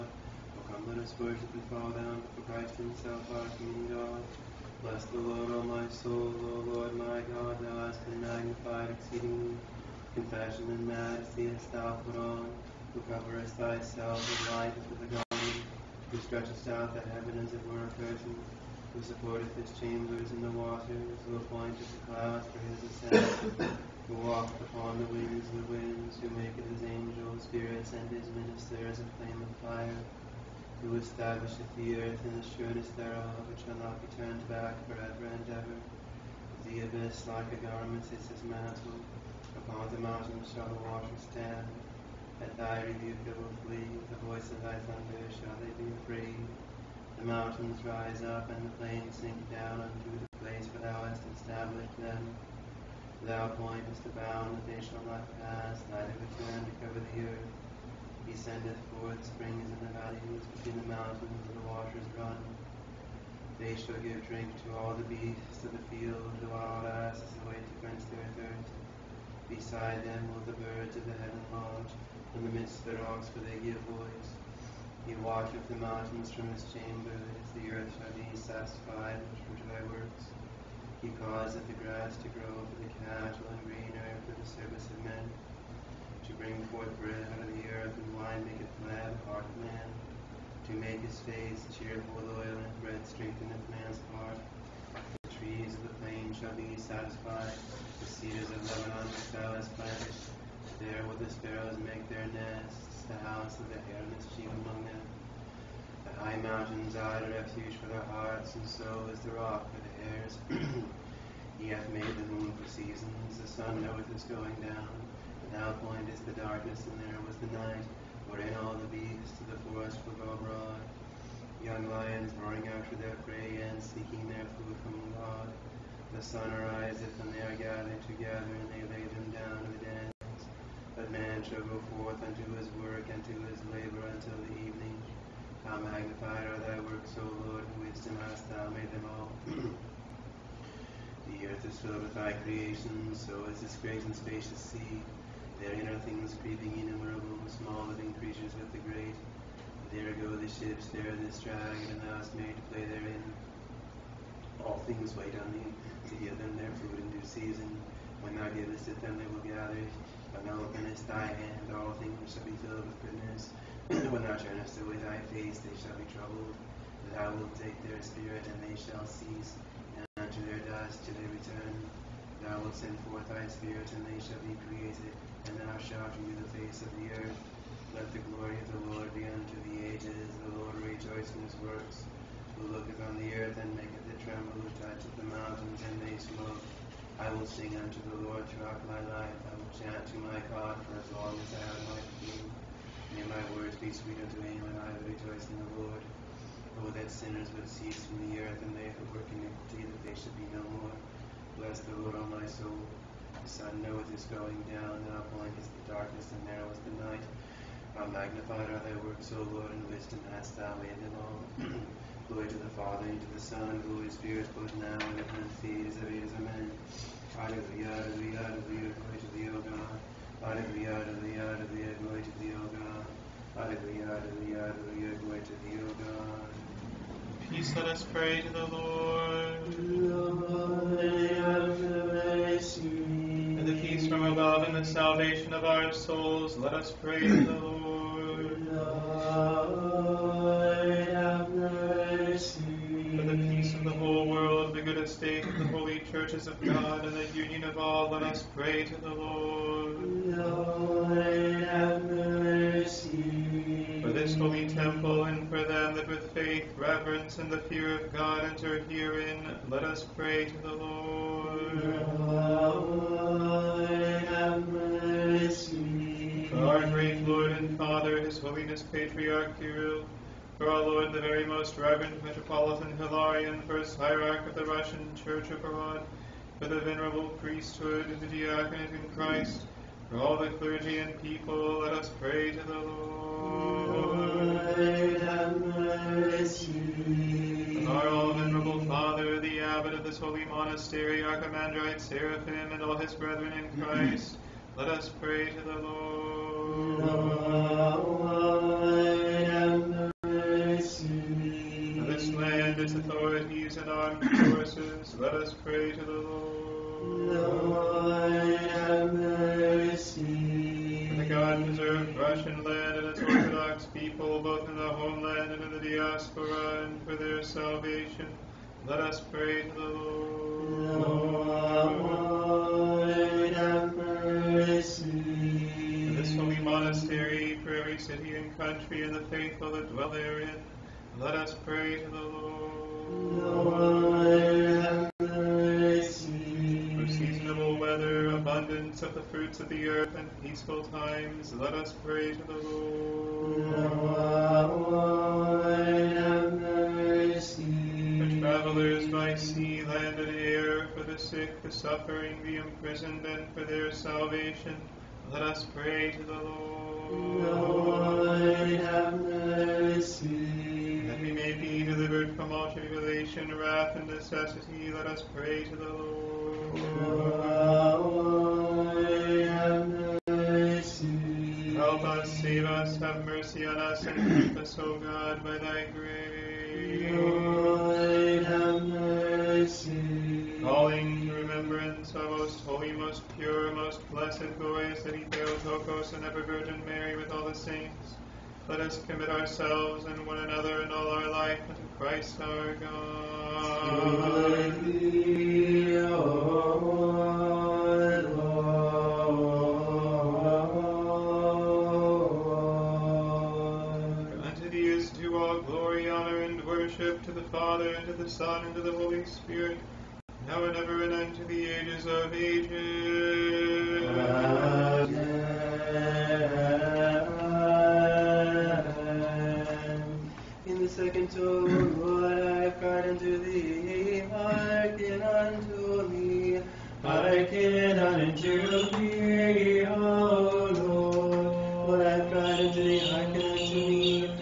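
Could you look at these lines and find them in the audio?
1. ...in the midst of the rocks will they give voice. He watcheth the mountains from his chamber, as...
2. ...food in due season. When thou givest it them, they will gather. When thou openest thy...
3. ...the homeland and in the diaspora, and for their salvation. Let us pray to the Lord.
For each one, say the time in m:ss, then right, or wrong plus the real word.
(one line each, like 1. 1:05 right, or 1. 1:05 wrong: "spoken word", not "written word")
1. 1:12 right
2. 2:36 right
3. 5:14 right.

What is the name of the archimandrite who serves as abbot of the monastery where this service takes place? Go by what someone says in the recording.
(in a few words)
Seraphim.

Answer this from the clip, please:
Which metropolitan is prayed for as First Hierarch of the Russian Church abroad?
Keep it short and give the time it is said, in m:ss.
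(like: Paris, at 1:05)
Metropolitan Hilarion, at 4:32.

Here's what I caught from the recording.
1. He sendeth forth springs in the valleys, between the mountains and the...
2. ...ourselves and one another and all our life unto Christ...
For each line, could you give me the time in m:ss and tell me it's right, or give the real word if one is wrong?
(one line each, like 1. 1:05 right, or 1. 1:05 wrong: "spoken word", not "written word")
1. 0:58 right
2. 6:29 right.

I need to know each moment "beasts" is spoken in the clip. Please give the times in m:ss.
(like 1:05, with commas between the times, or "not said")
1:05, 1:58.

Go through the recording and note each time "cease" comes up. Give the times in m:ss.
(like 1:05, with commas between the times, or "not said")
2:49, 3:17.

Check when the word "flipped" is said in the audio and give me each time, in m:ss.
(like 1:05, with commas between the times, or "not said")
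not said.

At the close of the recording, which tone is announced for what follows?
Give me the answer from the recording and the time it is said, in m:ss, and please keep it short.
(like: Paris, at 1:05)
Second tone, at 7:00.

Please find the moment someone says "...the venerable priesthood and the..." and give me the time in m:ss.
4:36.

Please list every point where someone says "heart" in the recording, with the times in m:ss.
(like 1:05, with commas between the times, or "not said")
1:29, 1:34, 1:48.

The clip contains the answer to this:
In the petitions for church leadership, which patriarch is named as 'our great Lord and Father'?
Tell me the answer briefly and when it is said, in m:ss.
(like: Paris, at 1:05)
Patriarch Kirill, at 4:28.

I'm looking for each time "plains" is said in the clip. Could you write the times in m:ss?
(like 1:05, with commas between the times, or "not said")
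0:48, 1:36.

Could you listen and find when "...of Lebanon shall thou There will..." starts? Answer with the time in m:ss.
1:38.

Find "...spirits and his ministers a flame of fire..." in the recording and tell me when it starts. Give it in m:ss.
0:27.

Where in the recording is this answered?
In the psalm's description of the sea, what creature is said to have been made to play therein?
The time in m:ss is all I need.
2:31.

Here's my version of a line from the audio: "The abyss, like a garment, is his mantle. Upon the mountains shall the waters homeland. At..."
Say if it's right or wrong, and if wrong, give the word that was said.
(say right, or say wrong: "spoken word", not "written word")
wrong: "stand", not "homeland".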